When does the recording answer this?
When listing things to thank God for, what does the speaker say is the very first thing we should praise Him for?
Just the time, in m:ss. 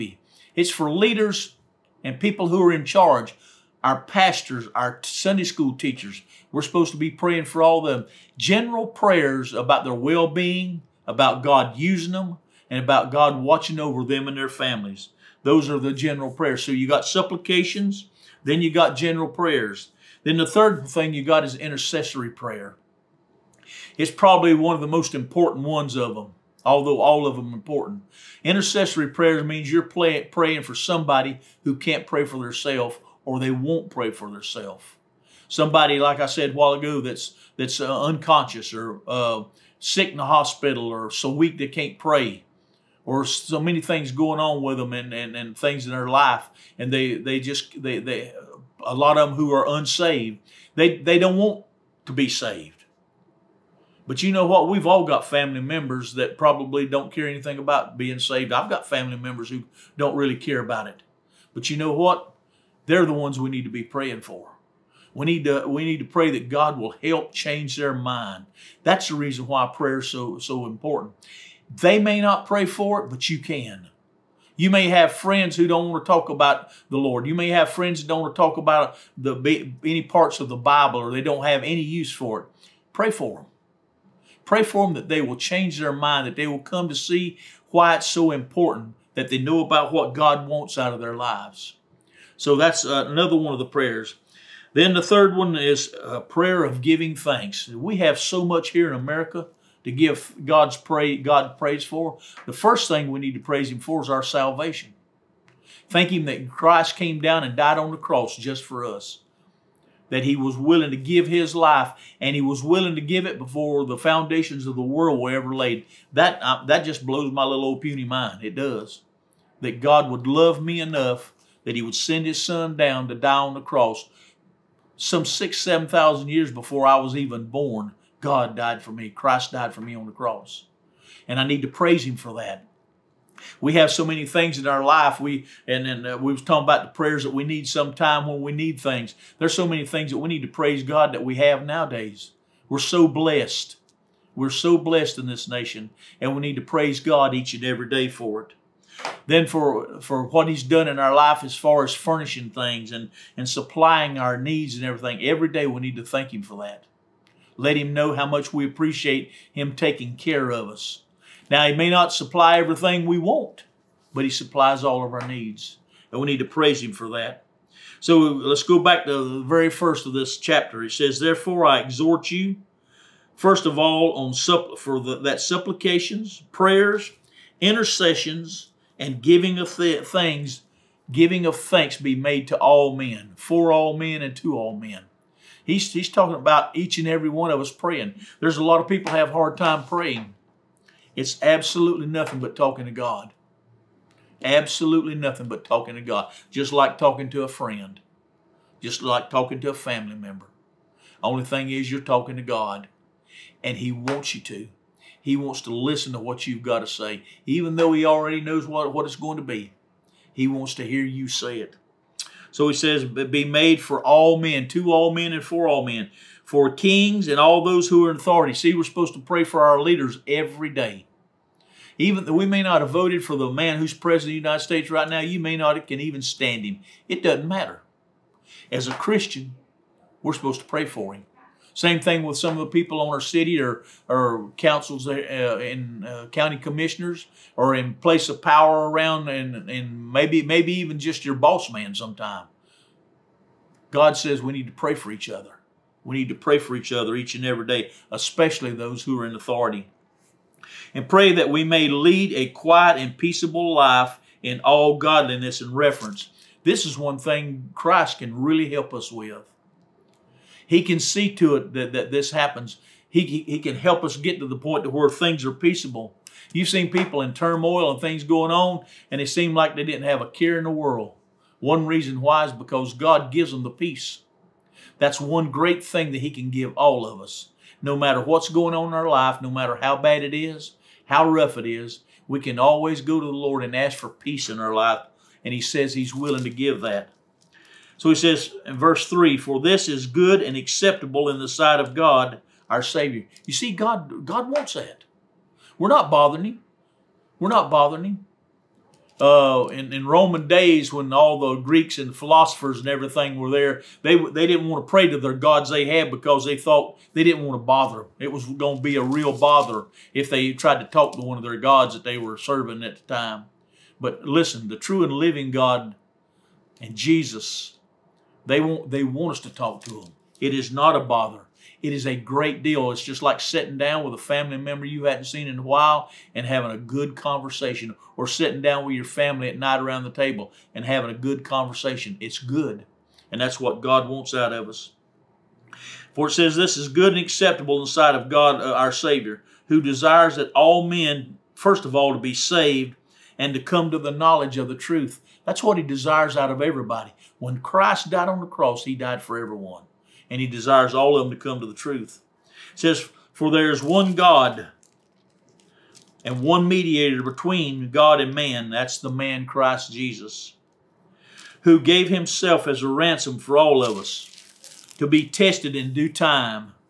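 1:44.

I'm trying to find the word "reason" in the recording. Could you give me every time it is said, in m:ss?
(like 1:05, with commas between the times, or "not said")
1:09, 4:31.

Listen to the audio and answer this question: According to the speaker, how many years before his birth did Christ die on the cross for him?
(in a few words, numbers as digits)
6,000-7,000.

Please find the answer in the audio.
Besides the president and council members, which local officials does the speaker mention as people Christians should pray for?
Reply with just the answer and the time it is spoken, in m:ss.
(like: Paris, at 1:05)
County commissioners, at 3:56.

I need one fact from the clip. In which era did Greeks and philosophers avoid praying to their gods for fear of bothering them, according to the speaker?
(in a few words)
Roman days.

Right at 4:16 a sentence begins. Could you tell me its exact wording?
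This is one thing Christ can really help us with.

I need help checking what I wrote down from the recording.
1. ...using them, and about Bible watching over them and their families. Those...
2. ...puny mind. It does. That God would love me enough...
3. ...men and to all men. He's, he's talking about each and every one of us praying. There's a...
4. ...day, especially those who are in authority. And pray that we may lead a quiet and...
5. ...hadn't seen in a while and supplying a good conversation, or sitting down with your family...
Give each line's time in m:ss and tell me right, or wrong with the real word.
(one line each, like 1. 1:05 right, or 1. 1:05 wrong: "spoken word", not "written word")
1. 0:11 wrong: "God", not "Bible"
2. 1:57 right
3. 3:03 right
4. 4:07 right
5. 5:25 wrong: "having", not "supplying".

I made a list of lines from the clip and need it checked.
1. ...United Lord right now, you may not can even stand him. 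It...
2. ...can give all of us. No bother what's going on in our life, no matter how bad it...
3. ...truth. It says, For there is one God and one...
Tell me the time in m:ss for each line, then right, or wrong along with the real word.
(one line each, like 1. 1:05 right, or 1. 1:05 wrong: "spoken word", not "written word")
1. 3:44 wrong: "States", not "Lord"
2. 4:36 wrong: "matter", not "bother"
3. 5:51 right.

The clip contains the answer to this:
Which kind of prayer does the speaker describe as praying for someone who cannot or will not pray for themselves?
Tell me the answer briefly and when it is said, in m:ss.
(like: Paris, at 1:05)
Intercessory prayer, at 0:21.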